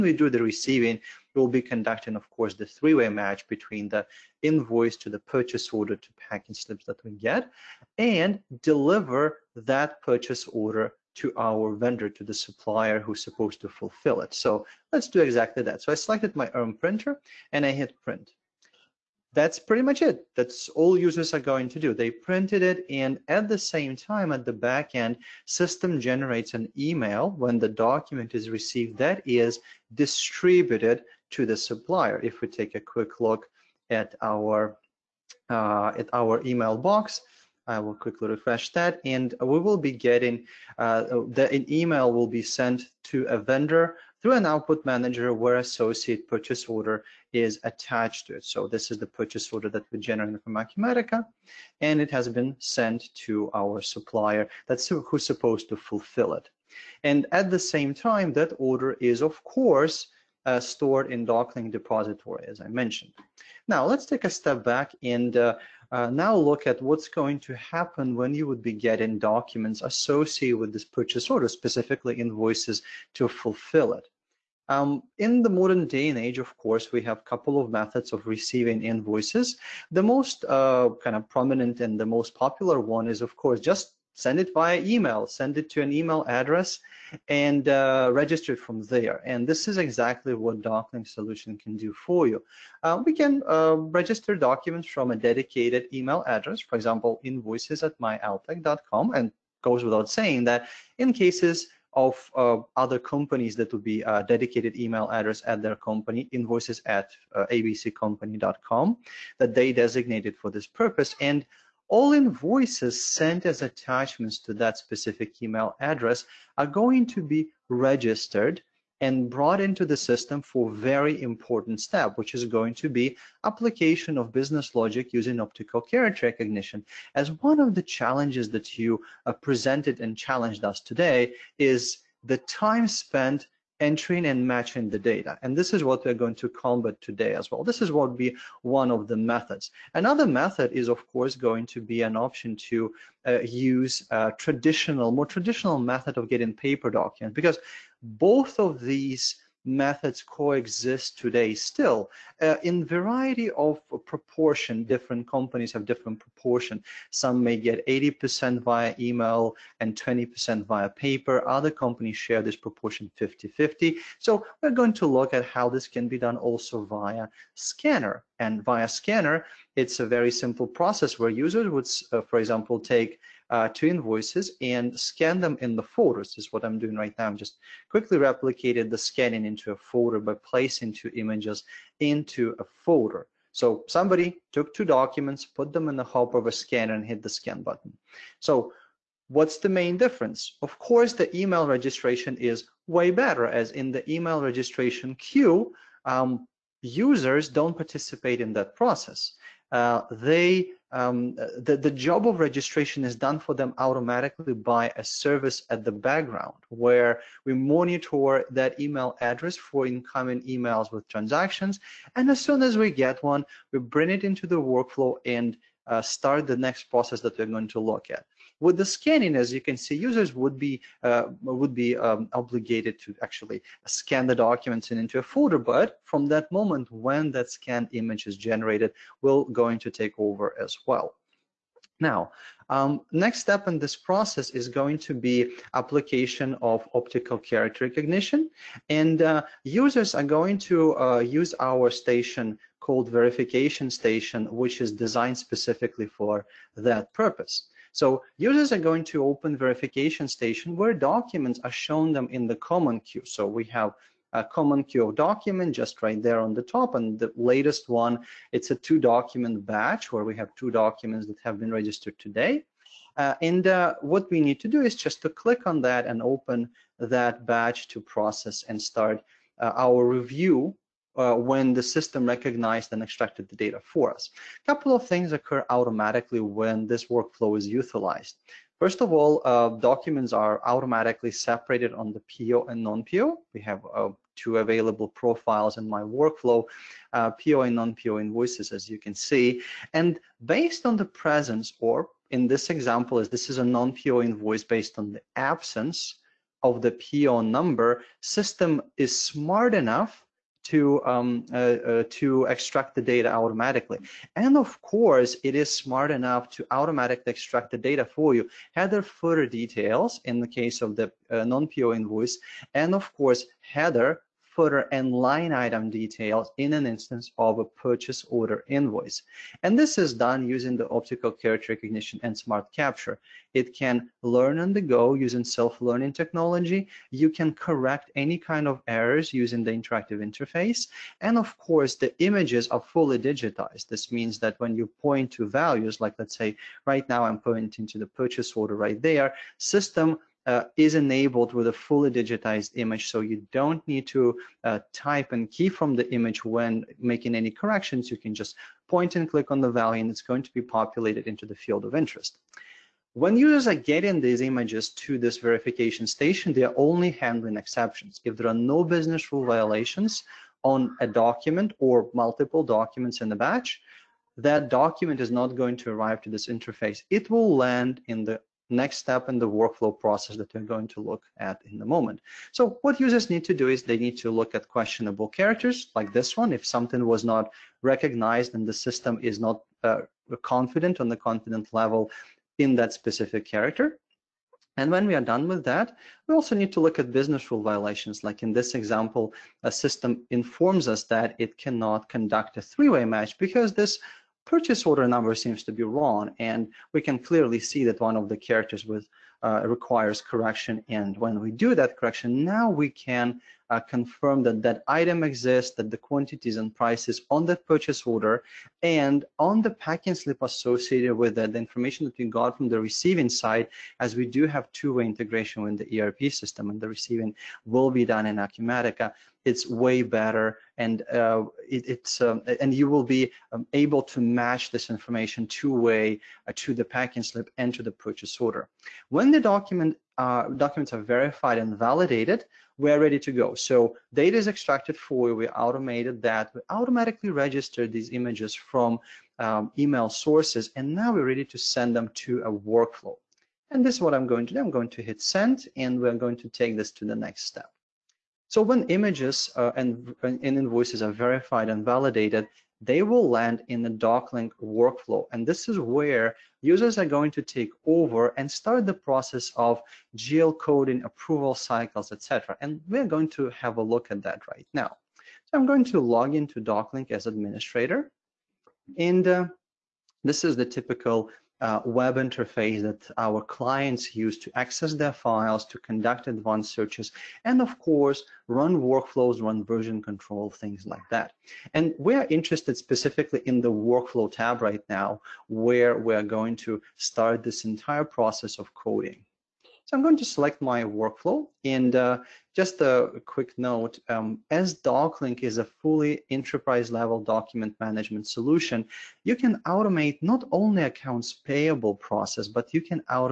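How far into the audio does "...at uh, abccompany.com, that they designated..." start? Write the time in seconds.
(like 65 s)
106 s.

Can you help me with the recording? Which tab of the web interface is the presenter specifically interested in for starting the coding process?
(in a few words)
workflow tab.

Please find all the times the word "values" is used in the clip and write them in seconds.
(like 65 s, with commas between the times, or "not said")
335 s, 349 s.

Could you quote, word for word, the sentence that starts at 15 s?
So I selected my own printer and I hit print that's pretty much it.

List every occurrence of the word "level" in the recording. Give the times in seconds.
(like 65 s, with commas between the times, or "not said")
381 s, 496 s.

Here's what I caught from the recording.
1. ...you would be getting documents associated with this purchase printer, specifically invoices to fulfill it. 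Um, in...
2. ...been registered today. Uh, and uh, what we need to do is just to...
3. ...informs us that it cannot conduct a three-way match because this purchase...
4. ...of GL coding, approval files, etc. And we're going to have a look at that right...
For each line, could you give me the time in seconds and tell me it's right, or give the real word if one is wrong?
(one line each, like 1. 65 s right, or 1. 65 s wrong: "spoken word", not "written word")
1. 68 s wrong: "order", not "printer"
2. 261 s right
3. 390 s right
4. 459 s wrong: "cycles", not "files".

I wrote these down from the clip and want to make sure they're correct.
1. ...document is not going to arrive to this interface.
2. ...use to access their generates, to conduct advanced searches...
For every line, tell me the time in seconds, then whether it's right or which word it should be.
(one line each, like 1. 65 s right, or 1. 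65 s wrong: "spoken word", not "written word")
1. 364 s right
2. 474 s wrong: "files", not "generates".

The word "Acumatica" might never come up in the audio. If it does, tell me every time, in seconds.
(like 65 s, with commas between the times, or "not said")
50 s, 418 s.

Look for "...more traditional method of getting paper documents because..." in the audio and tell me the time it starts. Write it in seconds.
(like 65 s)
145 s.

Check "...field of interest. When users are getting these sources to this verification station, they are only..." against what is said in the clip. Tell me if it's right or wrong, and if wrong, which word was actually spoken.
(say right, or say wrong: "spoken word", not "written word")
wrong: "images", not "sources".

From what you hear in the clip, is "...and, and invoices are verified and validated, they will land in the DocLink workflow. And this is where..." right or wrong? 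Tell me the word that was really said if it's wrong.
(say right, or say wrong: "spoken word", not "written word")
right.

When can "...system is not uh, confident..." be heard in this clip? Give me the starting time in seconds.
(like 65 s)
378 s.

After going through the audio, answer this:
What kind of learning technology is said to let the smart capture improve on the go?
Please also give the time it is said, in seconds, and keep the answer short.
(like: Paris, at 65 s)
self-learning technology, at 325 s.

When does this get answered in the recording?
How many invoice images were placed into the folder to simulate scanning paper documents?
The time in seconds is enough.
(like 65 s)
173 s.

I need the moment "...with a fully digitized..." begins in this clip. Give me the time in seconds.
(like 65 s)
341 s.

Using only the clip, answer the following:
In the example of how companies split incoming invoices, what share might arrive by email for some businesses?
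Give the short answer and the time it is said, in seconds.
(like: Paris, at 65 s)
80%, at 157 s.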